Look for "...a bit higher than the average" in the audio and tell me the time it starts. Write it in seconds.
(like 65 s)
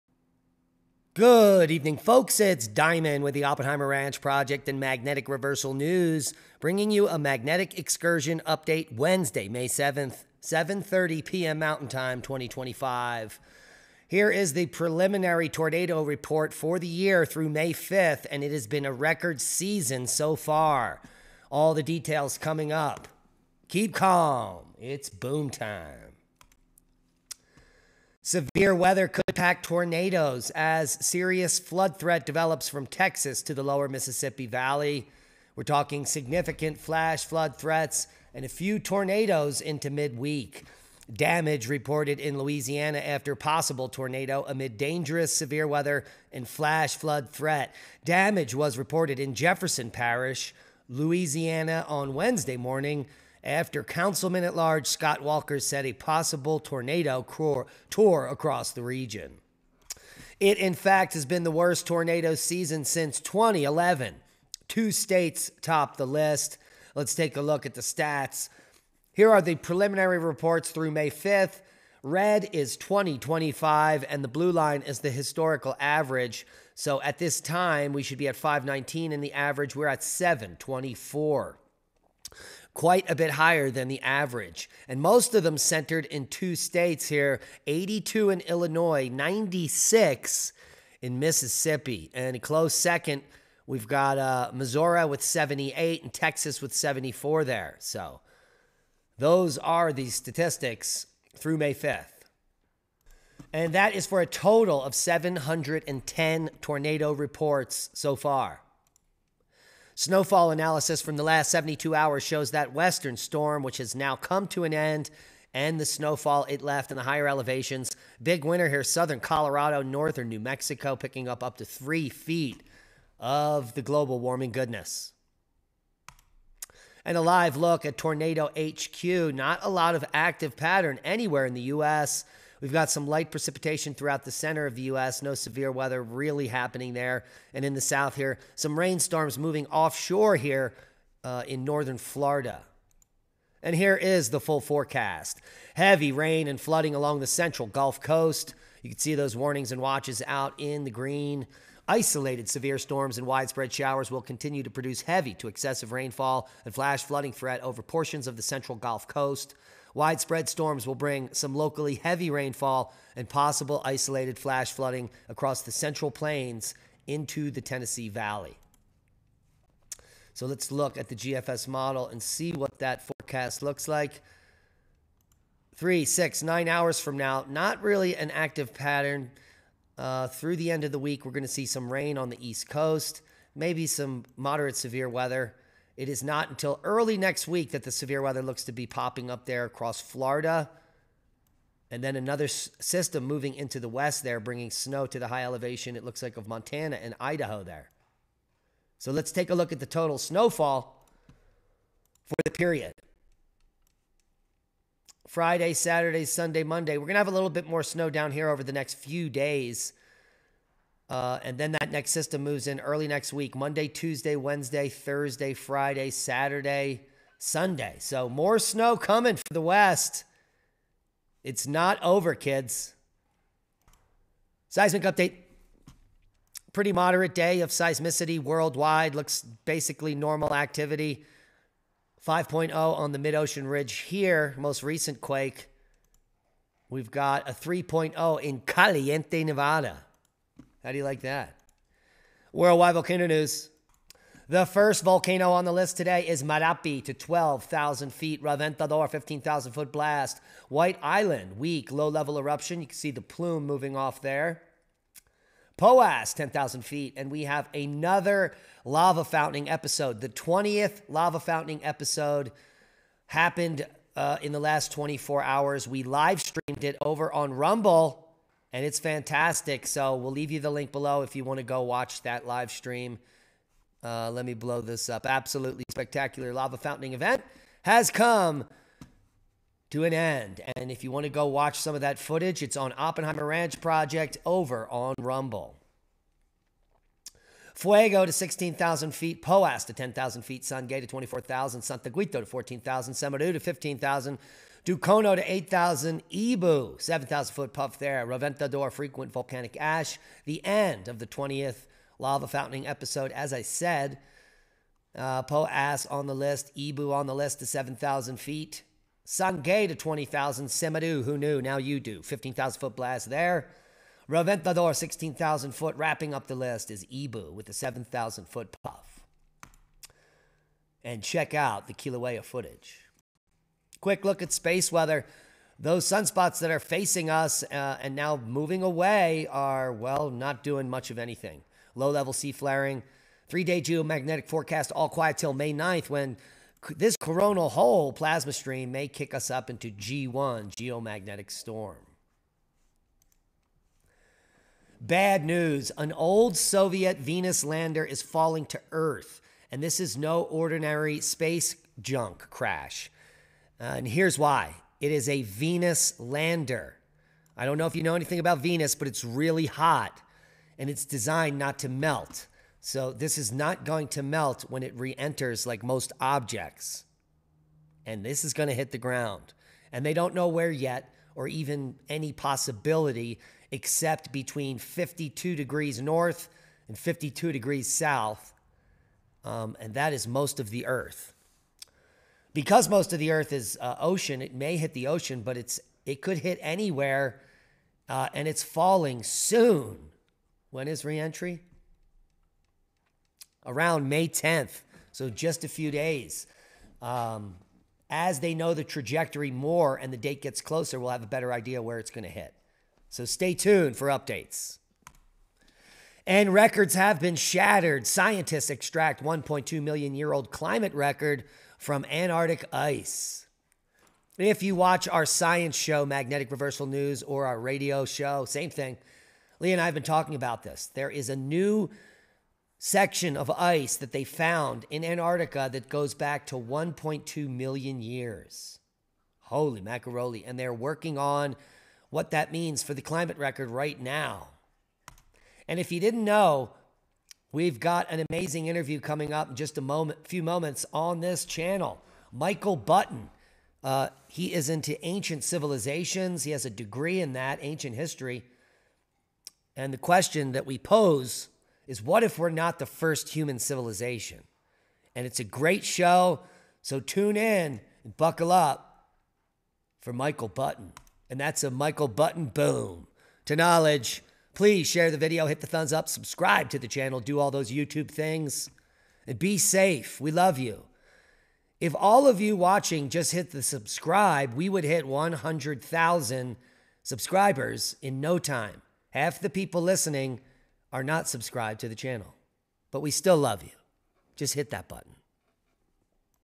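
83 s.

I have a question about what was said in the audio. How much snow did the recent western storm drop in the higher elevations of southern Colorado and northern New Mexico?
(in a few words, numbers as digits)
Up to three feet.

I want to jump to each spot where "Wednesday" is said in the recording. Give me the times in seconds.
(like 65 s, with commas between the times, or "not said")
8 s, 52 s, 214 s.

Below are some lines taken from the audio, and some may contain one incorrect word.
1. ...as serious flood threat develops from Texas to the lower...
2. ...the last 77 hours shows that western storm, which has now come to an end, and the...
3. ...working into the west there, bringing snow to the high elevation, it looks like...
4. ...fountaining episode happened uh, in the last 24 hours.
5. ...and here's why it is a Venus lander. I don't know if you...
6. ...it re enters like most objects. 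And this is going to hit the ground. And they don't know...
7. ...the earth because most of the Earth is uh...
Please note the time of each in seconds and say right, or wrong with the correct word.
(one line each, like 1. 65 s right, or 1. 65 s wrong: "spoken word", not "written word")
1. 30 s right
2. 111 s wrong: "72", not "77"
3. 193 s wrong: "moving", not "working"
4. 261 s right
5. 353 s right
6. 364 s right
7. 380 s right.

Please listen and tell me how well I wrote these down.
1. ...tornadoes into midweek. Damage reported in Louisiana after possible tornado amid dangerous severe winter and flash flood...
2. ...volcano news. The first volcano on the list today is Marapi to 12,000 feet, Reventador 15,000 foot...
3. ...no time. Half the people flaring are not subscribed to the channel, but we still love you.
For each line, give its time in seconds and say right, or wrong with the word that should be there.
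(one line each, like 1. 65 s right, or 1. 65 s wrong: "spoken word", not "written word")
1. 38 s wrong: "weather", not "winter"
2. 242 s right
3. 478 s wrong: "listening", not "flaring".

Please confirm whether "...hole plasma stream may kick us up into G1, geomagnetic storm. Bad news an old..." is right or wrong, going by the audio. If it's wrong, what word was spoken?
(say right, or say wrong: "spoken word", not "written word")
right.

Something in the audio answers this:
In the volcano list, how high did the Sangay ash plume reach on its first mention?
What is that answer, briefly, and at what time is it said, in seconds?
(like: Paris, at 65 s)
24,000 feet, at 290 s.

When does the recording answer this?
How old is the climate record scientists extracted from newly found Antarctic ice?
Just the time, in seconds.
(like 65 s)
409 s.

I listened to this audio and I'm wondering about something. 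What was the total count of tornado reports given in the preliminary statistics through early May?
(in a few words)
710.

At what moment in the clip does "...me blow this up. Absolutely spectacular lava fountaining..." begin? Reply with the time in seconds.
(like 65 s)
274 s.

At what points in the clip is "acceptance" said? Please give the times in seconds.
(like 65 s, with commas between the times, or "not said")
not said.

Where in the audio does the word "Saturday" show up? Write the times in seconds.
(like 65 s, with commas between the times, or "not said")
205 s, 216 s.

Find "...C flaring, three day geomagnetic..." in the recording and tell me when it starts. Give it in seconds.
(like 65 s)
332 s.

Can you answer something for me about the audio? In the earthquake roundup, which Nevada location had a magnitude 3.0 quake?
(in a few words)
Caliente.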